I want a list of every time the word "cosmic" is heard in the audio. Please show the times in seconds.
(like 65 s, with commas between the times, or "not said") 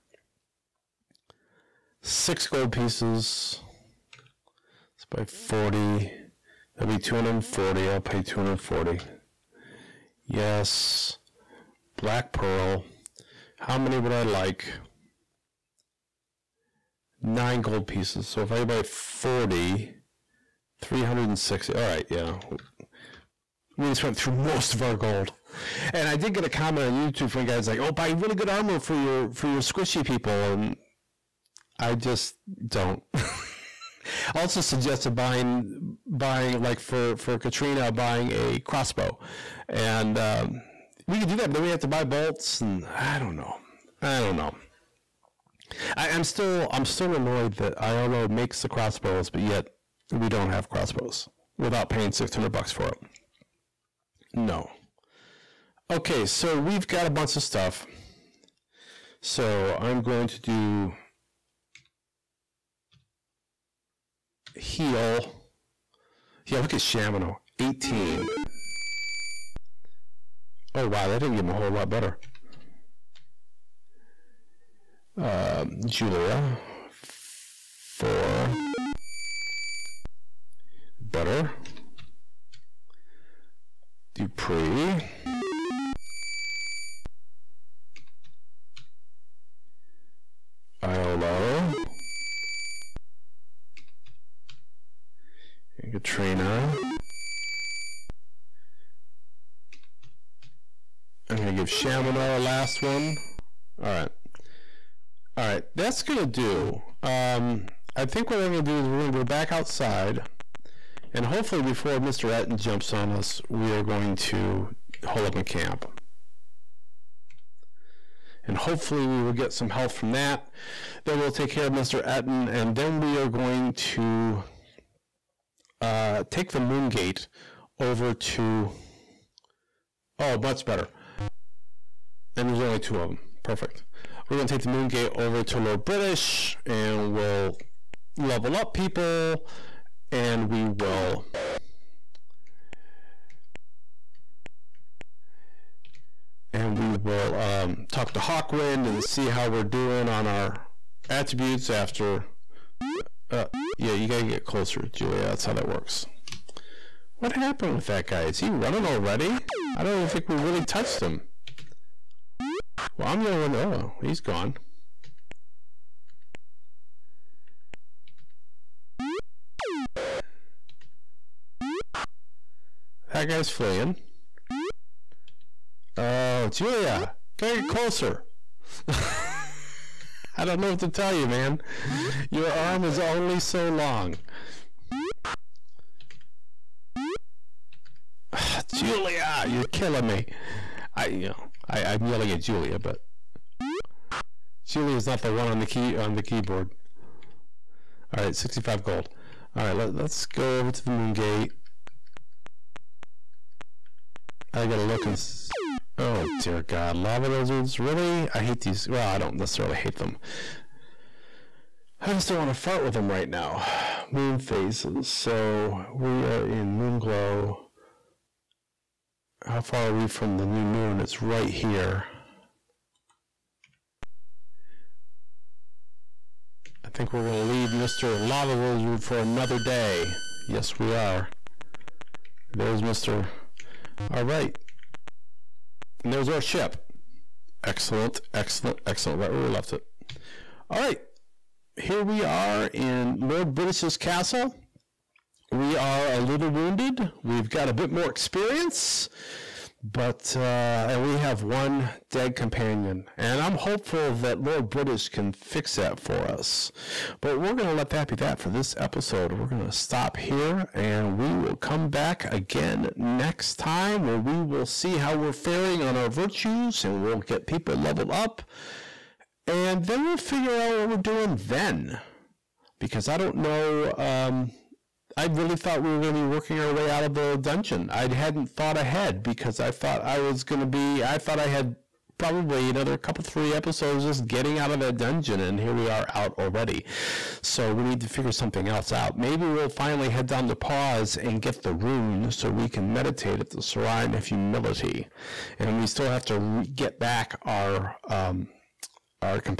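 not said.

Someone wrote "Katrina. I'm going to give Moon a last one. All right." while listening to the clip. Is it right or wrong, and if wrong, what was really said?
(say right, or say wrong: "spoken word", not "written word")
wrong: "Shamino", not "Moon".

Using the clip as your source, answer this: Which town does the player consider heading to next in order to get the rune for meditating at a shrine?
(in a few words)
Paws.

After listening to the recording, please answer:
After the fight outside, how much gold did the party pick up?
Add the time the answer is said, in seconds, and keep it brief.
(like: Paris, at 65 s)
65 gold, at 198 s.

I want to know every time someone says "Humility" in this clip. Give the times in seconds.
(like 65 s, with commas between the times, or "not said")
294 s.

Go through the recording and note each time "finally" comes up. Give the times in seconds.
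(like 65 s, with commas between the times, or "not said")
289 s.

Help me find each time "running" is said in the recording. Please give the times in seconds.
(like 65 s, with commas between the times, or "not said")
158 s.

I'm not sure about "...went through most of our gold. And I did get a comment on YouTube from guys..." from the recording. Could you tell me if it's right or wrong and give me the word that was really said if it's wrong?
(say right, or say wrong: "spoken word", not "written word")
right.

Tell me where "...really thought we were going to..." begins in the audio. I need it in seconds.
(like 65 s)
275 s.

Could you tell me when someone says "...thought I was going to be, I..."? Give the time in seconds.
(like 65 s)
279 s.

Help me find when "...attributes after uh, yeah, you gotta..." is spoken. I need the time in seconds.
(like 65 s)
151 s.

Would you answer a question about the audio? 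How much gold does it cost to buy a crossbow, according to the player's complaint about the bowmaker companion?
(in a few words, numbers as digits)
600.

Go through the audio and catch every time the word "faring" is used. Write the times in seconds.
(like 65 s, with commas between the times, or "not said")
265 s.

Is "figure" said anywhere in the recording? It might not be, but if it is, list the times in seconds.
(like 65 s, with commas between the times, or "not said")
270 s, 288 s.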